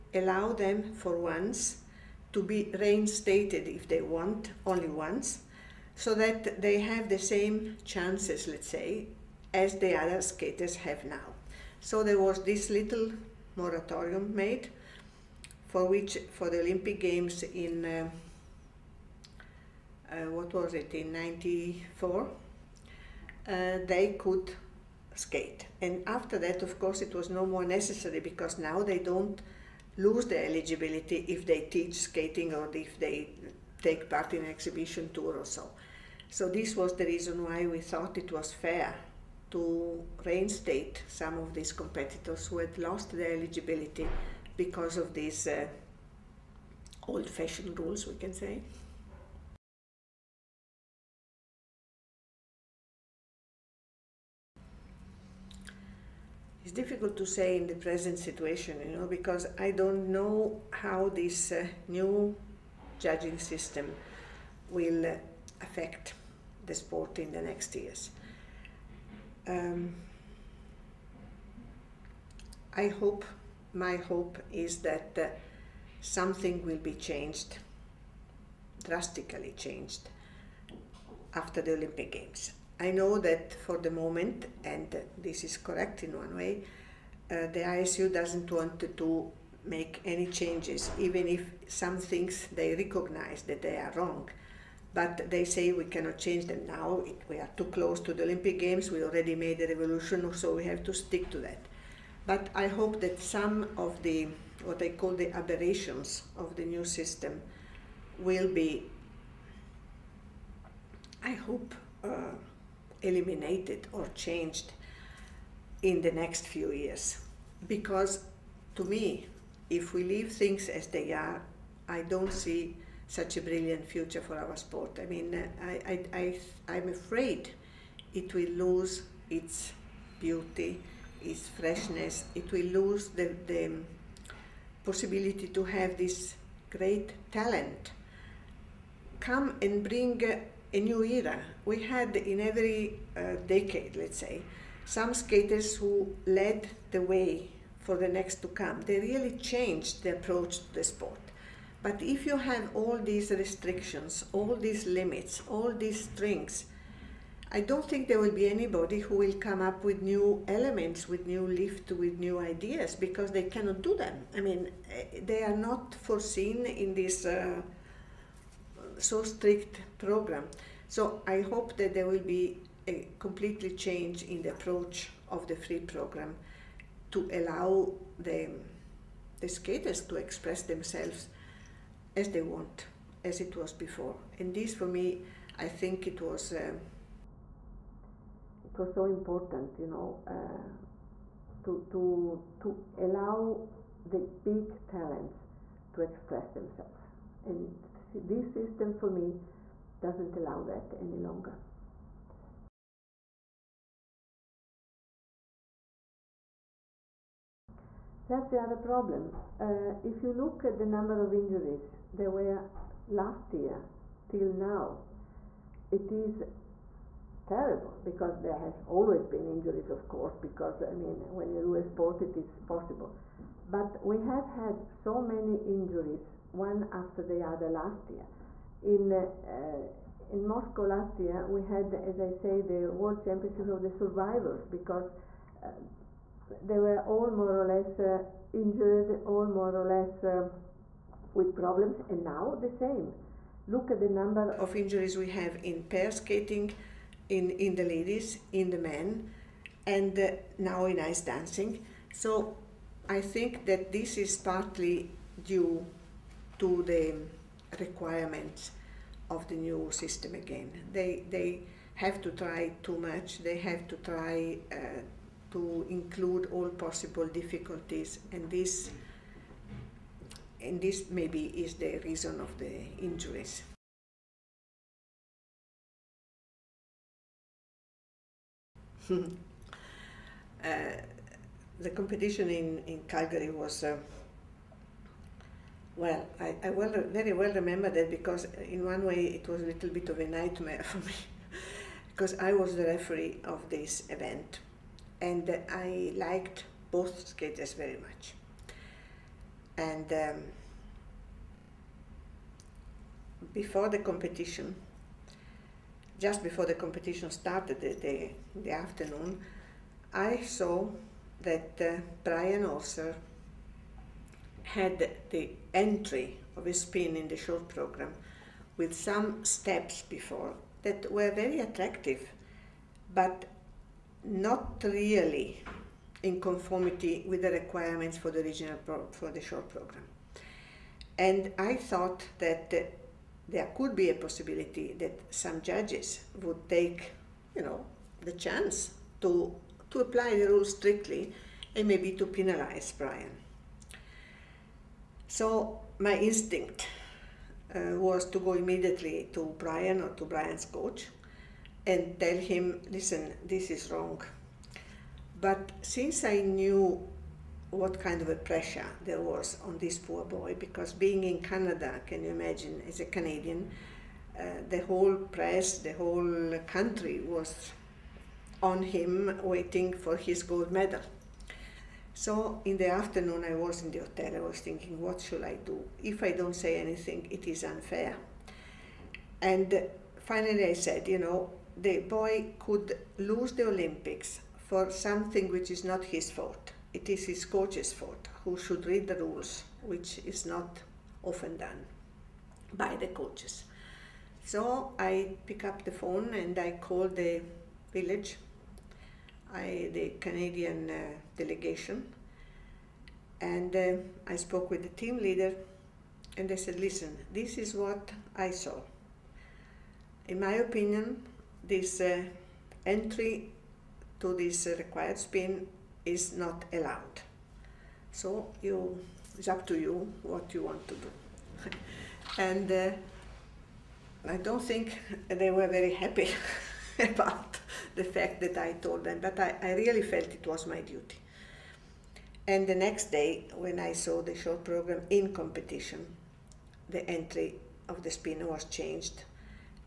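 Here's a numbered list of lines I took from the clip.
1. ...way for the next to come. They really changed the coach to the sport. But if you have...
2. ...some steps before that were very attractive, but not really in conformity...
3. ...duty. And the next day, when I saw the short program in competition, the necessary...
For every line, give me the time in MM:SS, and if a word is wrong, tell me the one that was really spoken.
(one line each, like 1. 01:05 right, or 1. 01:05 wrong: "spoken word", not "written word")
1. 02:27 wrong: "approach", not "coach"
2. 05:18 right
3. 07:10 wrong: "entry", not "necessary".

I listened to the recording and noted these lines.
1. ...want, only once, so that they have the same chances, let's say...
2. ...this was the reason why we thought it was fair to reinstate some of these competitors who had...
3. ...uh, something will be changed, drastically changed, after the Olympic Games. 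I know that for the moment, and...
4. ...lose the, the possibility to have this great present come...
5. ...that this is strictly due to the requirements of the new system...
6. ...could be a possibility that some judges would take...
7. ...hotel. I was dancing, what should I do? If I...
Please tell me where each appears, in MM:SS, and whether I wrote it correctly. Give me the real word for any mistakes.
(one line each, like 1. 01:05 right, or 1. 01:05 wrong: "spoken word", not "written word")
1. 00:04 right
2. 00:36 right
3. 01:15 right
4. 02:12 wrong: "talent", not "present"
5. 04:13 wrong: "partly", not "strictly"
6. 05:33 right
7. 06:13 wrong: "thinking", not "dancing".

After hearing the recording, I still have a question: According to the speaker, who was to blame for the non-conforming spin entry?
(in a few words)
his coach's.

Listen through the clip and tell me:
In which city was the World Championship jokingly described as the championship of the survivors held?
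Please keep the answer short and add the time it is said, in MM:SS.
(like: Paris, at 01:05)
Moscow, at 03:50.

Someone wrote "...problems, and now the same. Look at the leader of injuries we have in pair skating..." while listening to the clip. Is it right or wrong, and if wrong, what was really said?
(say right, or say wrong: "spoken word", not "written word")
wrong: "number", not "leader".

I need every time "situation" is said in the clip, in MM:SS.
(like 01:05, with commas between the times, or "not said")
00:58.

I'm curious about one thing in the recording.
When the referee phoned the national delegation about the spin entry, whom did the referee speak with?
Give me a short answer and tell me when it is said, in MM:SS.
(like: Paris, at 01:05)
the team leader, at 06:44.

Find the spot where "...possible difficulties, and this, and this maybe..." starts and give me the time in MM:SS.
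04:26.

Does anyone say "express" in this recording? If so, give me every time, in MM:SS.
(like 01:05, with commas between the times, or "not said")
03:00, 03:16.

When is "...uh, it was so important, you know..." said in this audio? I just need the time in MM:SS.
03:06.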